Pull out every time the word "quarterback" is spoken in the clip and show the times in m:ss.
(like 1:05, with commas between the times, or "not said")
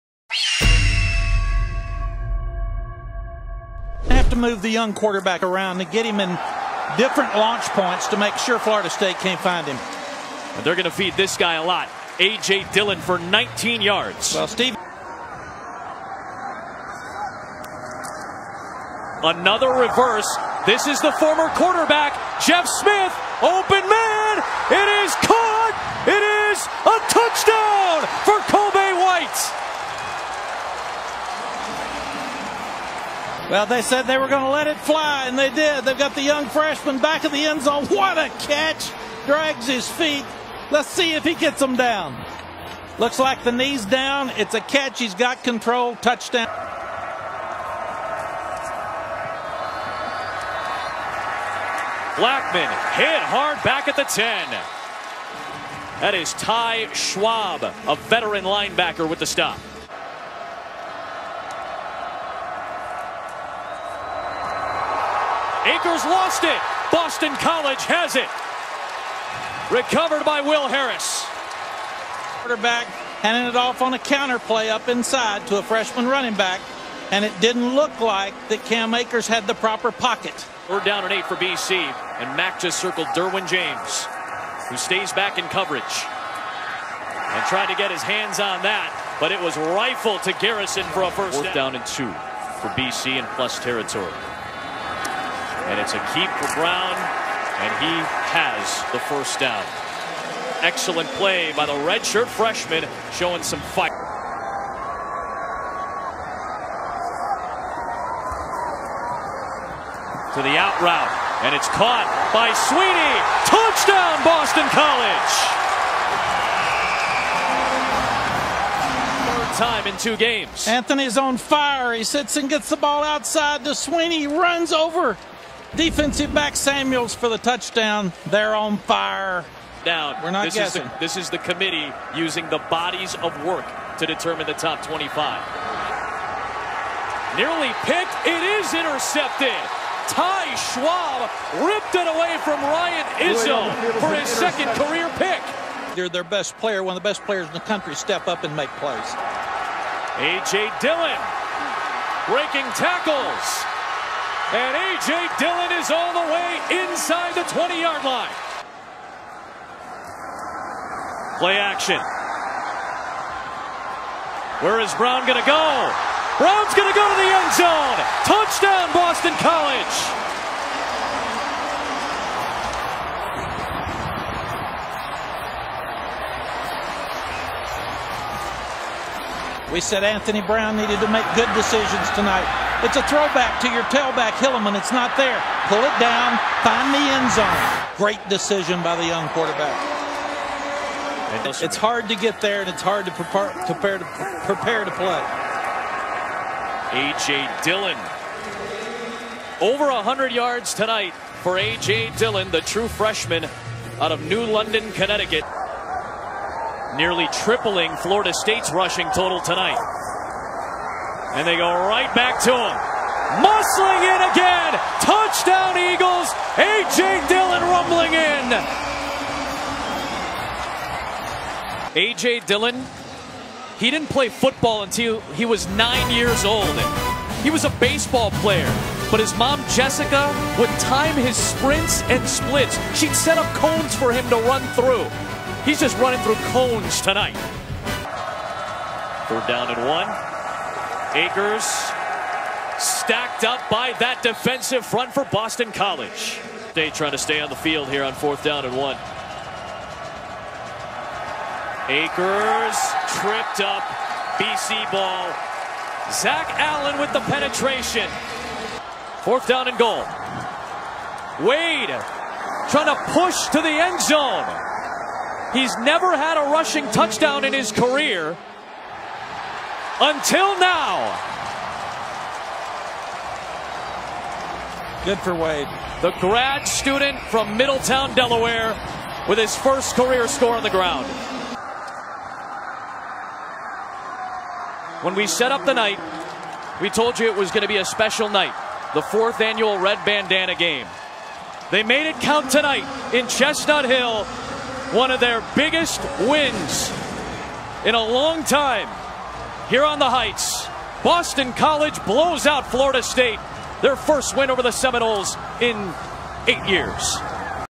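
0:04, 0:21, 1:12, 3:09.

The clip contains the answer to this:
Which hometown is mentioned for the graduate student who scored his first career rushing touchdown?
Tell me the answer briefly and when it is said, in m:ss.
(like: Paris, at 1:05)
Middletown, Delaware, at 4:37.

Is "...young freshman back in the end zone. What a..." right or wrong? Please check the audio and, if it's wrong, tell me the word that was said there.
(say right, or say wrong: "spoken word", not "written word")
right.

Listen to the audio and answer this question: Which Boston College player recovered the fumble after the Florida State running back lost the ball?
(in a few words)
Will Harris.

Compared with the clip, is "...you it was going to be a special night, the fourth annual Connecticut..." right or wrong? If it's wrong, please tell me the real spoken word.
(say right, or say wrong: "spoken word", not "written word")
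wrong: "Red", not "Connecticut".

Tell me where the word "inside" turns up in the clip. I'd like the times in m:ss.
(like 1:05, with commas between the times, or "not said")
1:14, 2:36.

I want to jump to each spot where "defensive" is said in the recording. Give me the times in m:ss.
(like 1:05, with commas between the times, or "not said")
2:05, 4:04.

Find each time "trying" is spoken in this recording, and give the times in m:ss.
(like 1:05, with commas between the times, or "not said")
4:06, 4:22.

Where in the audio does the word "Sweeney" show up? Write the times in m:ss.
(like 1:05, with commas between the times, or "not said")
1:52, 2:03.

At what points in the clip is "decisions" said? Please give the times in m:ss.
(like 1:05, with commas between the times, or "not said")
3:01, 3:08.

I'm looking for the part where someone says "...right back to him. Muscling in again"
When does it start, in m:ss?
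3:31.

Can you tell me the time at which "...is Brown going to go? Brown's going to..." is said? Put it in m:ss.
2:44.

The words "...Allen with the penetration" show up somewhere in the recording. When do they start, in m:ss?
4:16.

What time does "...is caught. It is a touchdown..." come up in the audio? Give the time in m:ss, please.
0:25.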